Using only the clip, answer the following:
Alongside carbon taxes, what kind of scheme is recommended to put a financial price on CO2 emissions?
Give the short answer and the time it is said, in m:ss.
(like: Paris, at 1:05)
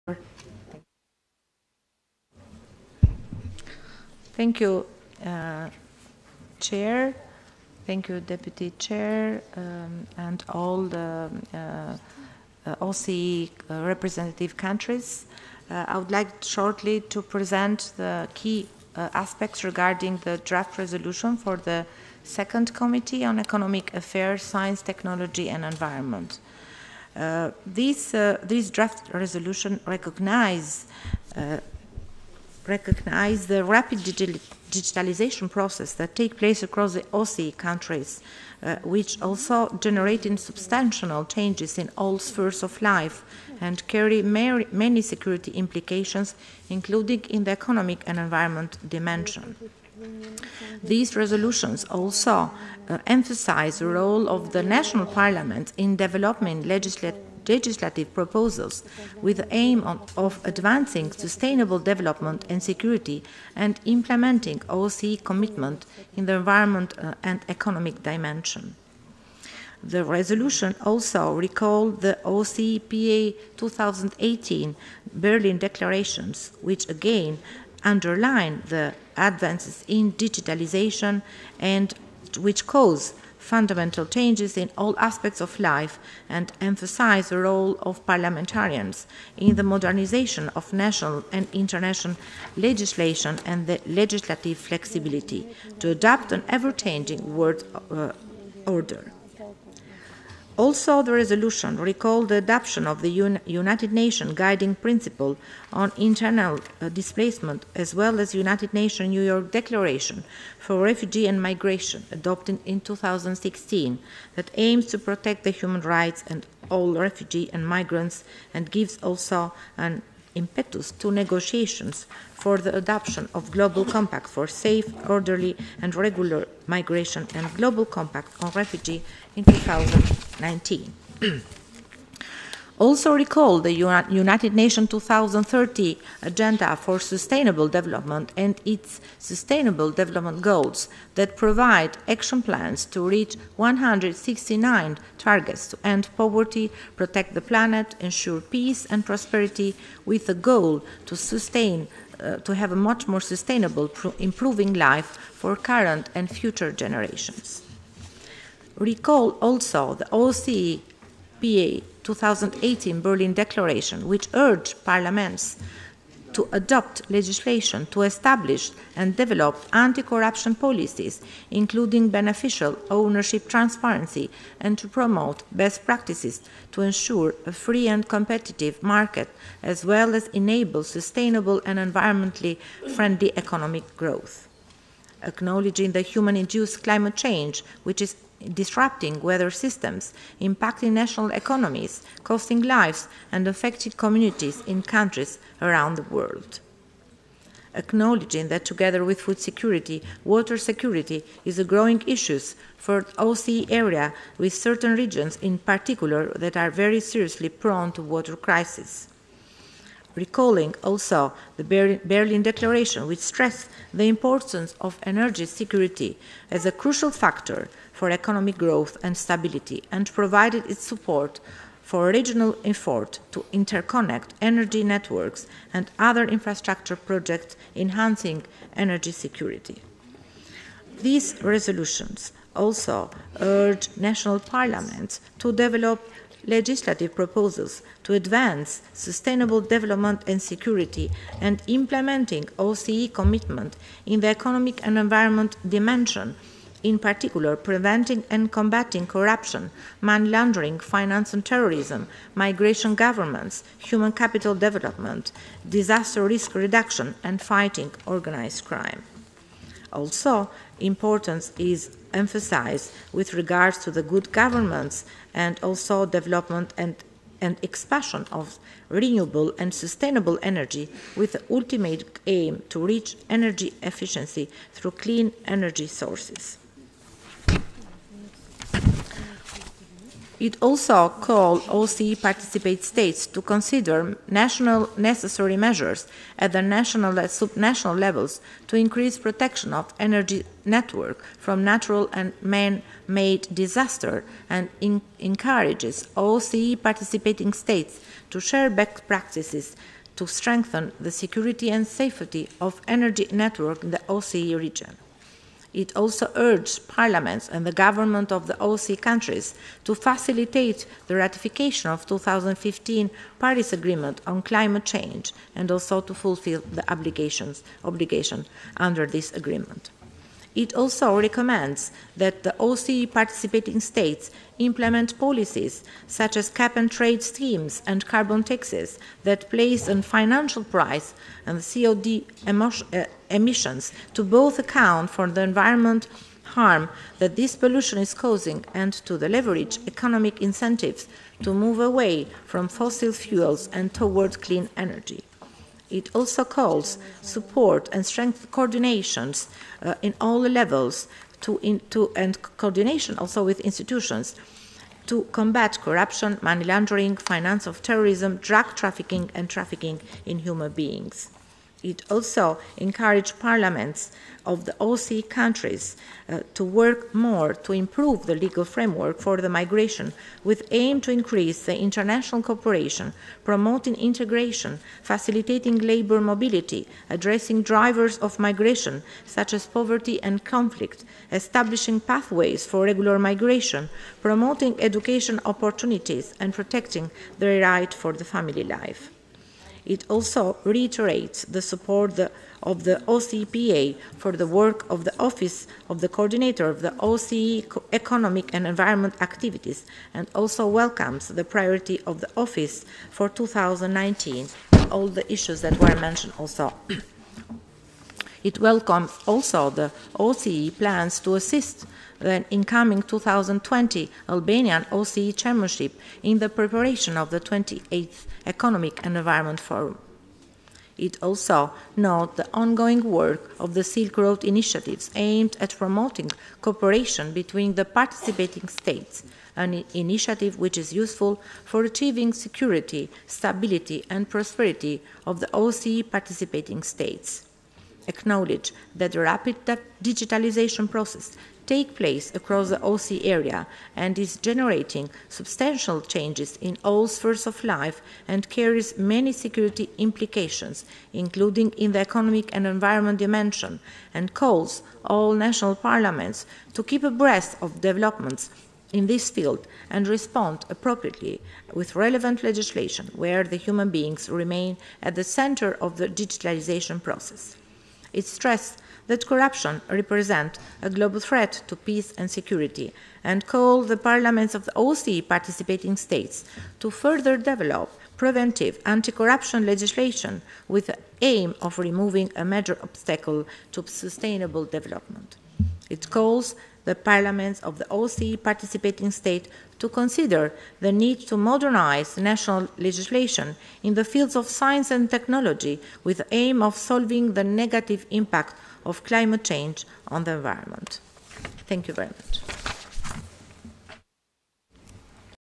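Cap and trade, at 5:26.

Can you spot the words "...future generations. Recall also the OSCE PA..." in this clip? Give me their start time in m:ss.
2:36.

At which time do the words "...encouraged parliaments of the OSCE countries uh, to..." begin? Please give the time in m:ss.
6:02.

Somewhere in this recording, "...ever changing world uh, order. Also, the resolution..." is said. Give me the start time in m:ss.
1:36.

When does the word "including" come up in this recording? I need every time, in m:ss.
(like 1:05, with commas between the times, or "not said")
0:46, 2:51, 7:31.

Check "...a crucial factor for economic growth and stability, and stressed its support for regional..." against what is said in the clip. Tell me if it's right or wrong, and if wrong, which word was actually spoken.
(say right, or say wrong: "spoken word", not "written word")
wrong: "provided", not "stressed".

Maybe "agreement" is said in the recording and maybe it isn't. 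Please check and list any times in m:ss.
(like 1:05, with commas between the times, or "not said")
5:13, 5:19.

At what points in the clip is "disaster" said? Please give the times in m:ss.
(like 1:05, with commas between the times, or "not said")
4:15, 4:53.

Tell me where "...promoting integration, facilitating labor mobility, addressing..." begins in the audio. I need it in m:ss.
6:13.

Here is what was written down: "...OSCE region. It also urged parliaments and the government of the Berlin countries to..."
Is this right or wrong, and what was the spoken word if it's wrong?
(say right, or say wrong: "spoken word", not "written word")
wrong: "OSCE", not "Berlin".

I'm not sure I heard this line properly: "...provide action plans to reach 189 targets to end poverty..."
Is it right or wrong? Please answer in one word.
wrong.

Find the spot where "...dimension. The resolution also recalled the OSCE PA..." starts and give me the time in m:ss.
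1:08.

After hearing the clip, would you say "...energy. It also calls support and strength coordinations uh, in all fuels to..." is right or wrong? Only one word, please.
wrong.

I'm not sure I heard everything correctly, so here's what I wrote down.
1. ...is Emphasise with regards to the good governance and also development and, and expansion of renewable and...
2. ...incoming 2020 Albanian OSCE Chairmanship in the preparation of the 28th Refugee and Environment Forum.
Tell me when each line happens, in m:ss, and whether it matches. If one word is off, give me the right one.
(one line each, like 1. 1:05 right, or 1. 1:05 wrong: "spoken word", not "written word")
1. 4:21 right
2. 6:52 wrong: "Economic", not "Refugee".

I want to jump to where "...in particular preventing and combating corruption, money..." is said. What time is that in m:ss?
4:06.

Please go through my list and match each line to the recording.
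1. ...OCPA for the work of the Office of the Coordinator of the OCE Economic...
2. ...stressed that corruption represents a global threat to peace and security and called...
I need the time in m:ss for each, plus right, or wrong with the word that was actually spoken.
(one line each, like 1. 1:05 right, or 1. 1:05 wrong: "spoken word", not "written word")
1. 6:33 right
2. 7:48 right.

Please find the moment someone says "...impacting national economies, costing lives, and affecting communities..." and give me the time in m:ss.
3:10.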